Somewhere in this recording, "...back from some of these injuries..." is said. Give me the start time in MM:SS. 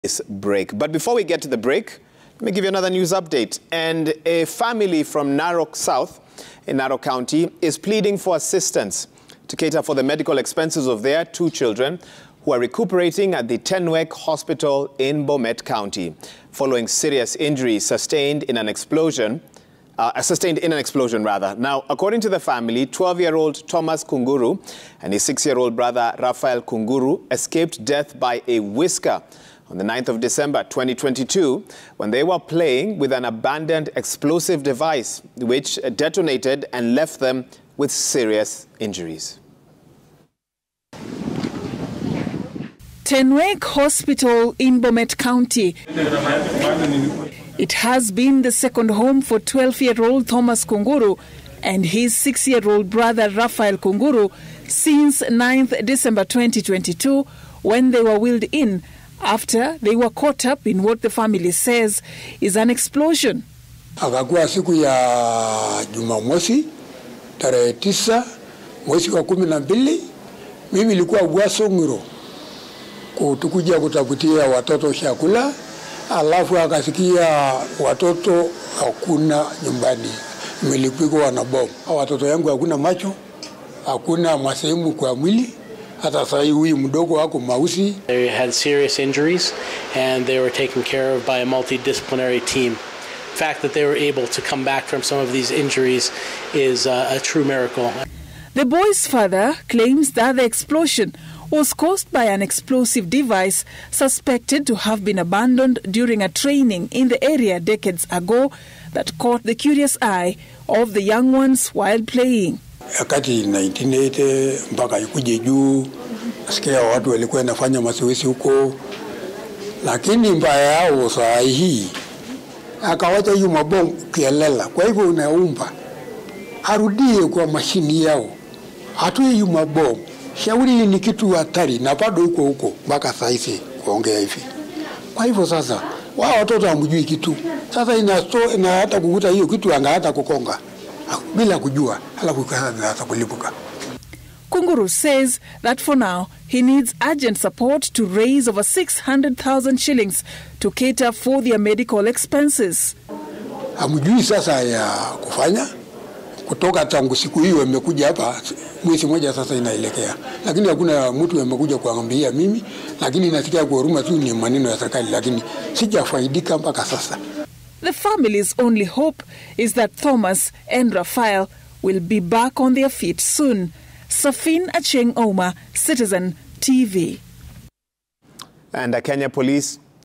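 01:34.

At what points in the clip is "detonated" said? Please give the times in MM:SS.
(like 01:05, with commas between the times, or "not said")
00:35.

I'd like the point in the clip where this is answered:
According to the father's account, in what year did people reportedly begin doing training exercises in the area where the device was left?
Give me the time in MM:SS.
01:53.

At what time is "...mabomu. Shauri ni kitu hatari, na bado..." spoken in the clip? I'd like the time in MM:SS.
02:09.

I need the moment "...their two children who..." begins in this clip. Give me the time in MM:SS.
00:11.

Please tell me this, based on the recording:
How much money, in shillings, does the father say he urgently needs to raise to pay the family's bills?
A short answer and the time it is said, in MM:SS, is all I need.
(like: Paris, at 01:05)
600,000 shillings, at 02:28.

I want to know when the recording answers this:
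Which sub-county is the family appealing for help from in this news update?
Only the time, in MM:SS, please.
00:05.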